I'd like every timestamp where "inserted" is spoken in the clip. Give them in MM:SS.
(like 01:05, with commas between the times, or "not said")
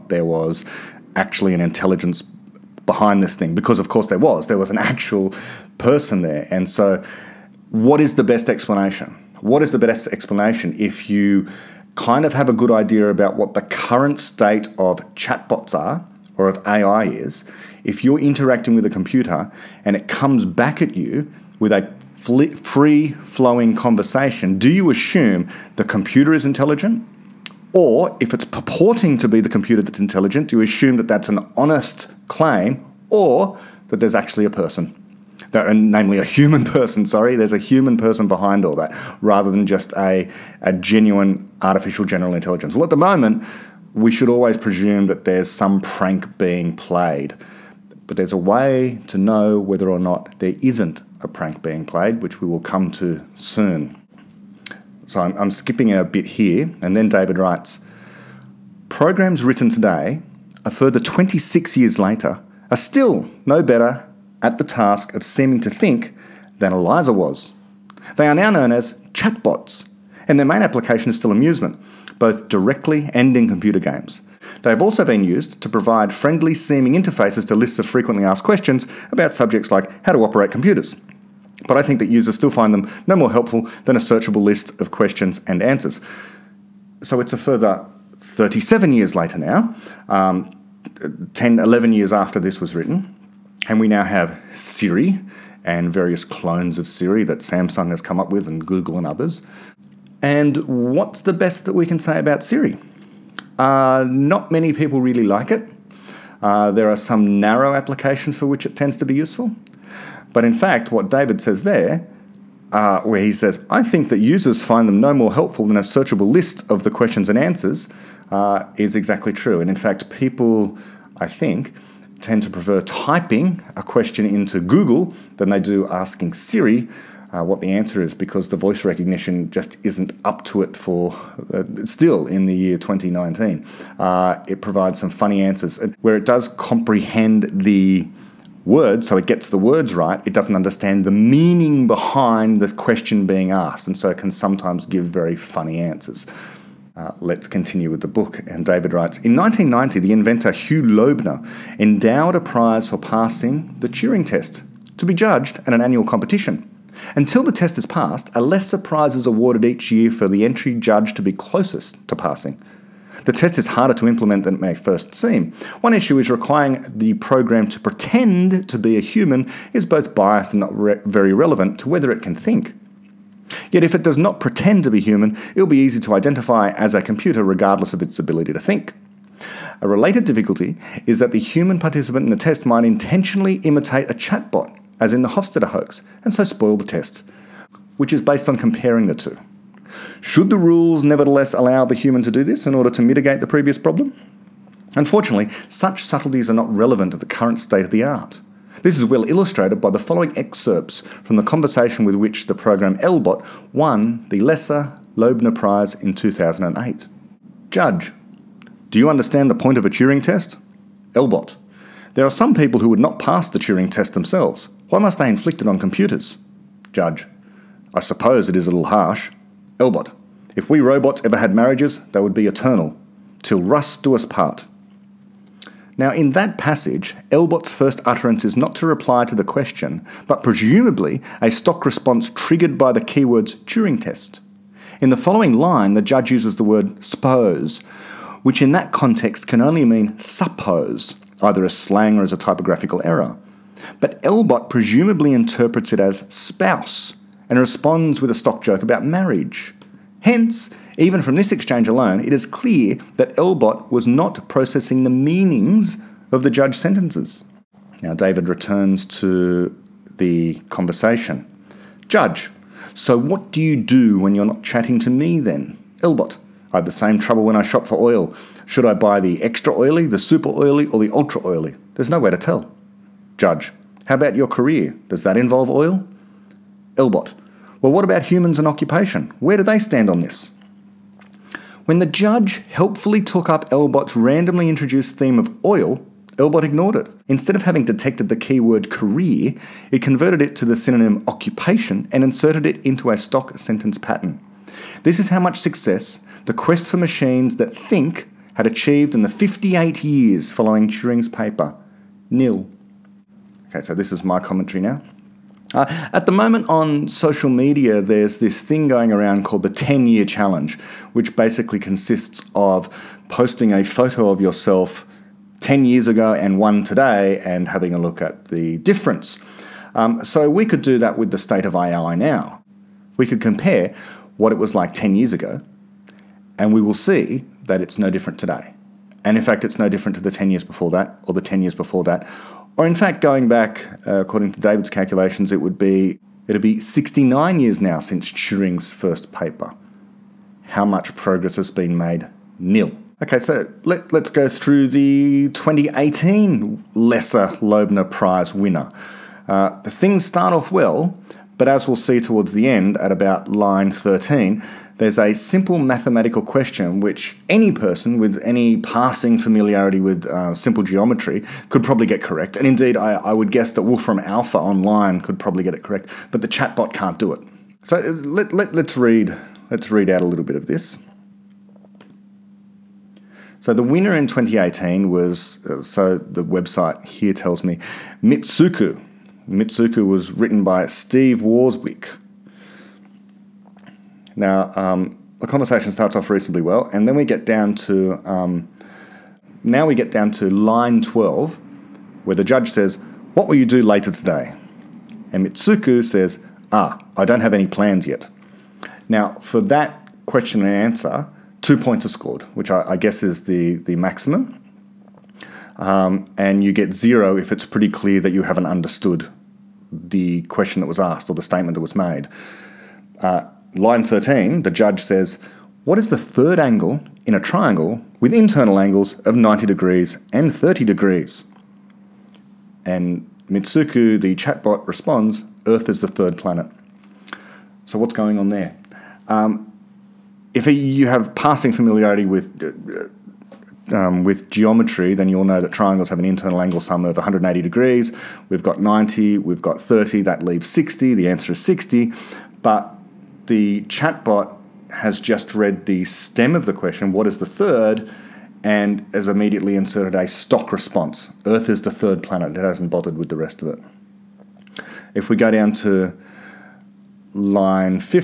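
04:52, 07:29.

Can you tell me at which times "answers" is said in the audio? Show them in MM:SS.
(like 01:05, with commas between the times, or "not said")
01:25, 01:57, 02:07, 02:15, 02:25, 06:40, 07:21.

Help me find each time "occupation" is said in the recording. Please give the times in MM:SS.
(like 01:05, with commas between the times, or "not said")
04:38, 04:51.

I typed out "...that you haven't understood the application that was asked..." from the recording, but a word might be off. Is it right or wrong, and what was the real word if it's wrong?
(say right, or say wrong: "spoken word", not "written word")
wrong: "question", not "application".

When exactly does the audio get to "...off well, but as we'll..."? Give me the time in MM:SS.
05:50.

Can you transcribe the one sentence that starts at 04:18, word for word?
Now, David returns to the conversation.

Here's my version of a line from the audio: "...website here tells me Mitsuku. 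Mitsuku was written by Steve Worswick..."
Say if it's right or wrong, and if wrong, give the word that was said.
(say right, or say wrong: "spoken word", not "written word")
right.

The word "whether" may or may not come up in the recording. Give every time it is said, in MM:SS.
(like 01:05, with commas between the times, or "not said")
00:49, 02:51.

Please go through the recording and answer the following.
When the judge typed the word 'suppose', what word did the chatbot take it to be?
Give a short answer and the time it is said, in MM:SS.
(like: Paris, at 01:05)
spouse, at 04:06.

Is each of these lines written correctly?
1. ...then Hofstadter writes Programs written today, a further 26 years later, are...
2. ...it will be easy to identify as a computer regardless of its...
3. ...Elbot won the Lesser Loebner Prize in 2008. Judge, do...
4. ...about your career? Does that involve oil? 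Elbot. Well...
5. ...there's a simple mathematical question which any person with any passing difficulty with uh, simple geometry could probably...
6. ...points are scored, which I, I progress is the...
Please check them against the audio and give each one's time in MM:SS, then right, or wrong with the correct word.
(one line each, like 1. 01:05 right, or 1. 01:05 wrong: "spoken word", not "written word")
1. 00:56 wrong: "David", not "Hofstadter"
2. 02:55 right
3. 03:22 right
4. 04:34 right
5. 05:54 wrong: "familiarity", not "difficulty"
6. 06:41 wrong: "guess", not "progress".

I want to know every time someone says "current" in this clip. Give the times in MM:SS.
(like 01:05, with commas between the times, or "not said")
00:13, 03:17.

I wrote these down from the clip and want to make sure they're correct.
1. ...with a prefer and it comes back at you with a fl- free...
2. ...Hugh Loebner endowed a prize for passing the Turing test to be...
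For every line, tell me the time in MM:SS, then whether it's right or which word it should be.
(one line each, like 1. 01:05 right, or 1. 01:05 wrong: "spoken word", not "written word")
1. 00:18 wrong: "computer", not "prefer"
2. 02:30 right.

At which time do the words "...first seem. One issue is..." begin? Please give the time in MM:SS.
02:44.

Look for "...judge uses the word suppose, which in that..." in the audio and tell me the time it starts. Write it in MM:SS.
03:56.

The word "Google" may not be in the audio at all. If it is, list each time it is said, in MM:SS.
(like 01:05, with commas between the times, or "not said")
01:38, 02:04.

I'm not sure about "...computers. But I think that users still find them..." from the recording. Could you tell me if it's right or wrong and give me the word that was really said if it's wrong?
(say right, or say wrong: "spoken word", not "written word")
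right.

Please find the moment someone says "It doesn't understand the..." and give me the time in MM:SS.
02:20.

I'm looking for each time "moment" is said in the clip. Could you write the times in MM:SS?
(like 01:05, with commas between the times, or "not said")
00:42, 05:06.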